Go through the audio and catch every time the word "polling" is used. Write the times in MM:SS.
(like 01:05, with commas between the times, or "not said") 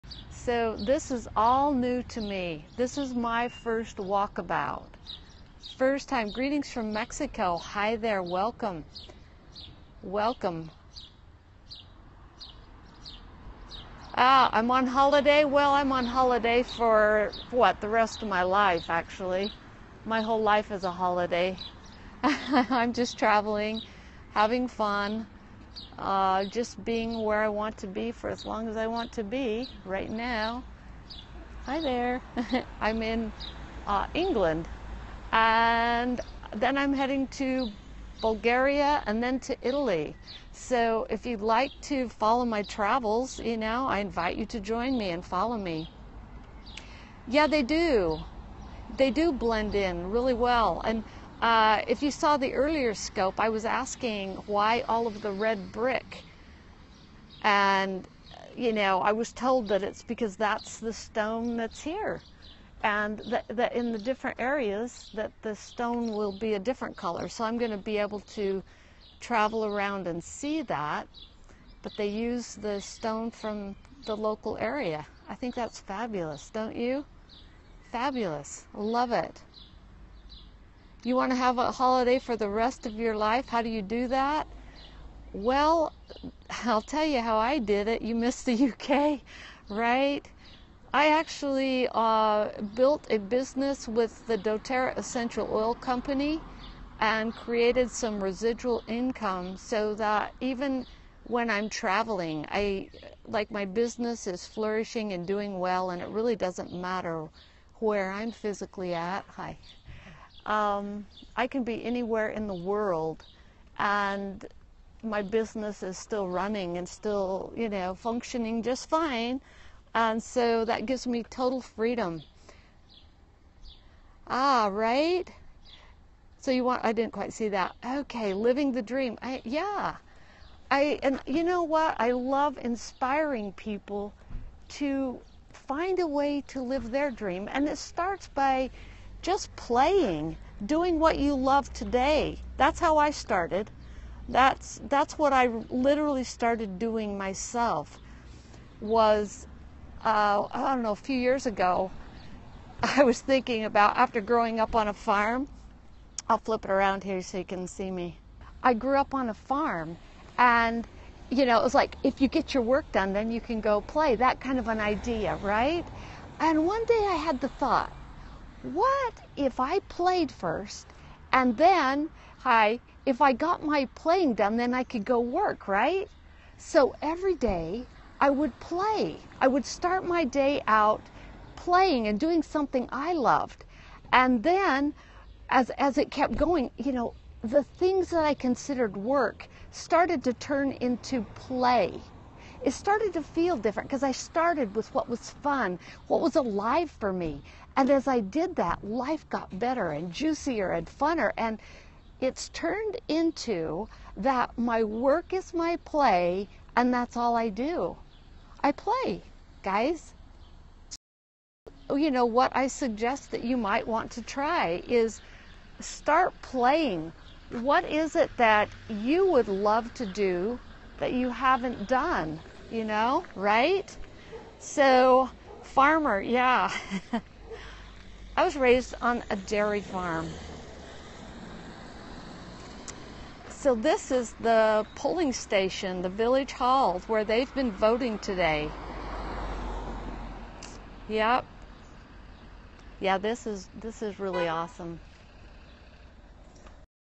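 03:54.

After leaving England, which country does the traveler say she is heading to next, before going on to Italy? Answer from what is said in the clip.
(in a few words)
Bulgaria.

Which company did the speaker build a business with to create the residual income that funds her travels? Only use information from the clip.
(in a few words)
doTERRA Essential Oil Company.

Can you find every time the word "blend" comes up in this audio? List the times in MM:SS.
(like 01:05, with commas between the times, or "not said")
00:49.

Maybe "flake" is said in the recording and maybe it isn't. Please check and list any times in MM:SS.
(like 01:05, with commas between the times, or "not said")
not said.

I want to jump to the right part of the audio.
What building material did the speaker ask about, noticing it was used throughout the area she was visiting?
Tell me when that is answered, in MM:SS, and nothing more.
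00:55.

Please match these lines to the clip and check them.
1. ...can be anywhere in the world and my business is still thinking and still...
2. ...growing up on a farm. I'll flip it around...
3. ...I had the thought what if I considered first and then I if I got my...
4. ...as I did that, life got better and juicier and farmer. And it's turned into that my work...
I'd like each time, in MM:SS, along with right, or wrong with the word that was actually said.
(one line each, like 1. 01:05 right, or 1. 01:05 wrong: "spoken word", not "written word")
1. 01:51 wrong: "running", not "thinking"
2. 02:34 right
3. 02:47 wrong: "played", not "considered"
4. 03:17 wrong: "funner", not "farmer".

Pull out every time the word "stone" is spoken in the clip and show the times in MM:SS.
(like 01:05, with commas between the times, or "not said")
01:00, 01:05, 01:12.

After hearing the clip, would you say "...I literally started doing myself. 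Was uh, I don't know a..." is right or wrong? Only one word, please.
right.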